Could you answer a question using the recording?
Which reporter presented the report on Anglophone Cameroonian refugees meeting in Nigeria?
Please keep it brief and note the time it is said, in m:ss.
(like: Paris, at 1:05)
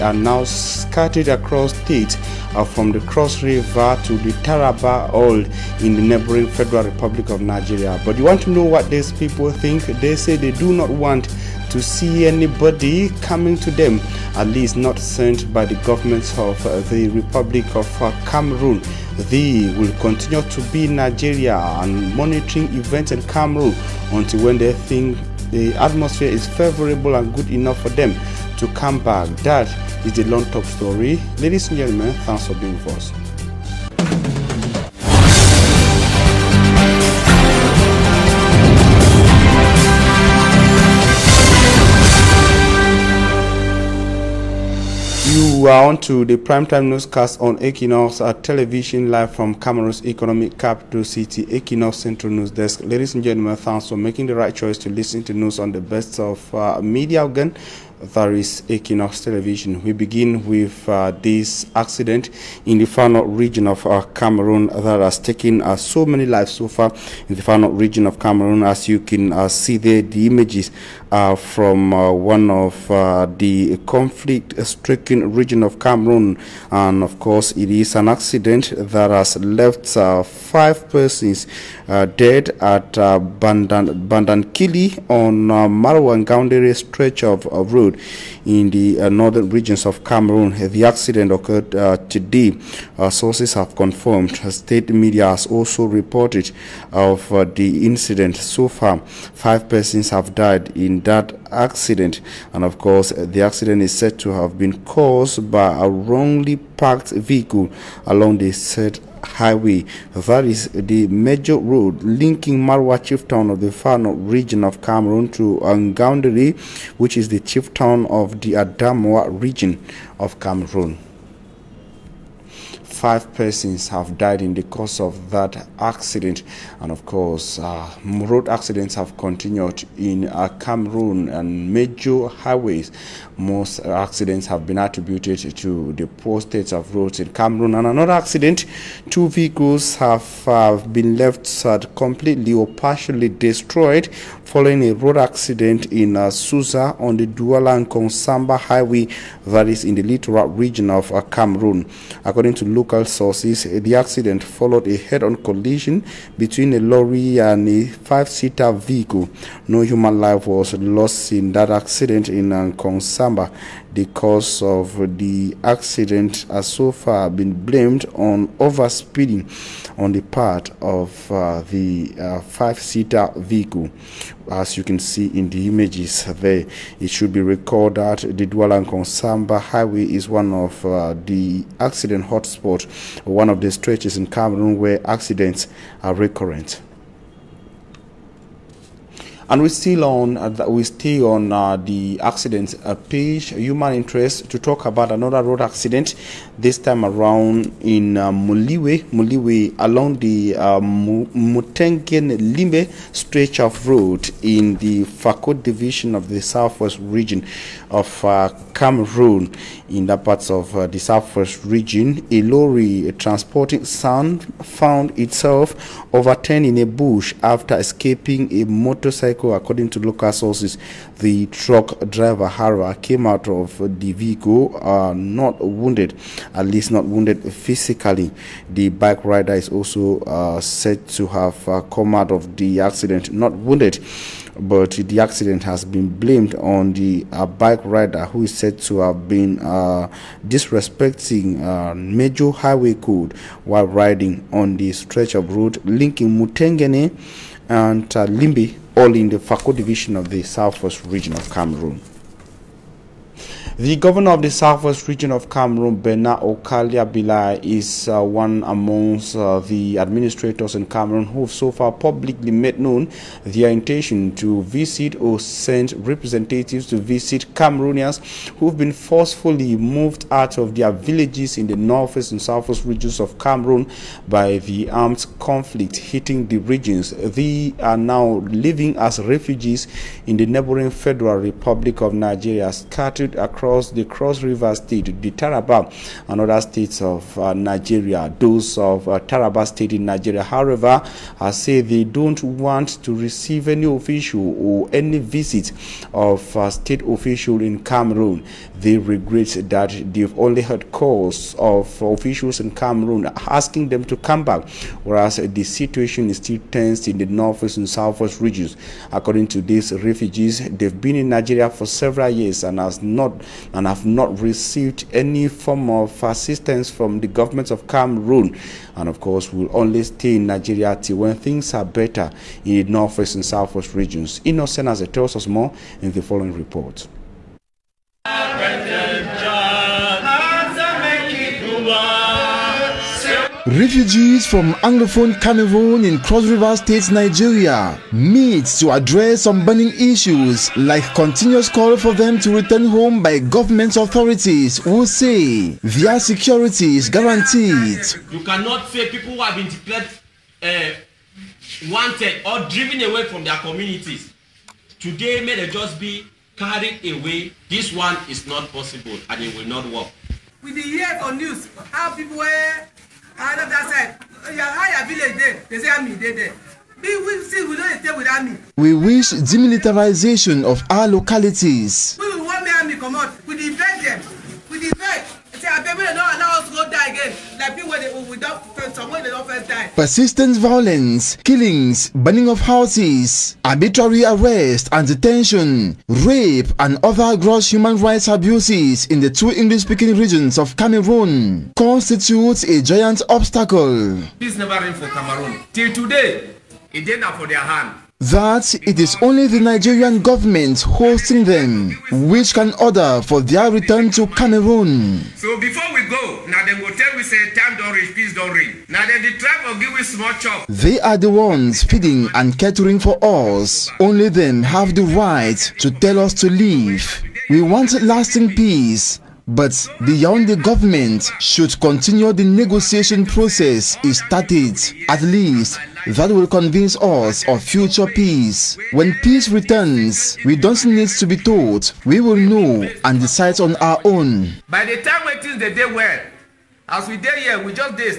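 Innocent Aze, at 5:24.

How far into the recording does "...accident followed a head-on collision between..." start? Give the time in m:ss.
2:33.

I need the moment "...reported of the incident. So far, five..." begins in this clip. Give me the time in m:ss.
1:35.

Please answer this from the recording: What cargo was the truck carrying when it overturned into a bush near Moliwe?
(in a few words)
Sand.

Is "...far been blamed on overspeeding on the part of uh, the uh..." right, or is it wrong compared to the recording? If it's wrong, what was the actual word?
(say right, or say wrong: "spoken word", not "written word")
right.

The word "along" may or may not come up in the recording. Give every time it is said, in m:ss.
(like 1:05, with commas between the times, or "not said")
1:48, 3:19.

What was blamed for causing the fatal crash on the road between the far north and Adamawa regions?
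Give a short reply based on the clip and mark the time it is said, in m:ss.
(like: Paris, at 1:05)
A wrongly parked vehicle, at 1:45.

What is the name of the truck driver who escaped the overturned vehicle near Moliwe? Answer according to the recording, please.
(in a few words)
Hara.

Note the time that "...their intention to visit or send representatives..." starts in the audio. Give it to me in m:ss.
4:23.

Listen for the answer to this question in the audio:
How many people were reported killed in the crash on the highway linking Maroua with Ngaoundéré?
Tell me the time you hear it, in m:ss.
1:20.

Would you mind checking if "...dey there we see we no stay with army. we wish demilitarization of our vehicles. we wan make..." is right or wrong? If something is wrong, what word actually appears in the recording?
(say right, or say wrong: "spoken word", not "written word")
wrong: "localities", not "vehicles".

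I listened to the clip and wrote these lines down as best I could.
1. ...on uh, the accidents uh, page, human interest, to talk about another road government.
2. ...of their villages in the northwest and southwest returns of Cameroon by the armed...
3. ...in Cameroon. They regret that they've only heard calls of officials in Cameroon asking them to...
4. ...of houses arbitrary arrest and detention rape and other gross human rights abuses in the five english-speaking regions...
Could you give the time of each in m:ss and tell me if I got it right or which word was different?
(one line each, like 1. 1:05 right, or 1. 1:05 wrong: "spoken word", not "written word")
1. 3:11 wrong: "accident", not "government"
2. 4:30 wrong: "regions", not "returns"
3. 4:57 right
4. 6:22 wrong: "two", not "five".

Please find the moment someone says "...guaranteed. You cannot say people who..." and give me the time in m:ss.
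5:47.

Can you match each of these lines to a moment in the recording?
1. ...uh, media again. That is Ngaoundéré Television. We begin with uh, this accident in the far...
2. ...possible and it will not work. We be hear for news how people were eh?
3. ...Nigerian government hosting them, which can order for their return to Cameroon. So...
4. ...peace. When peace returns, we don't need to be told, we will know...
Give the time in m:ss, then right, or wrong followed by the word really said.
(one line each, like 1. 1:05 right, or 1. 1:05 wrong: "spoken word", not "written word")
1. 0:56 wrong: "Equinox", not "Ngaoundéré"
2. 5:58 right
3. 6:39 right
4. 7:08 right.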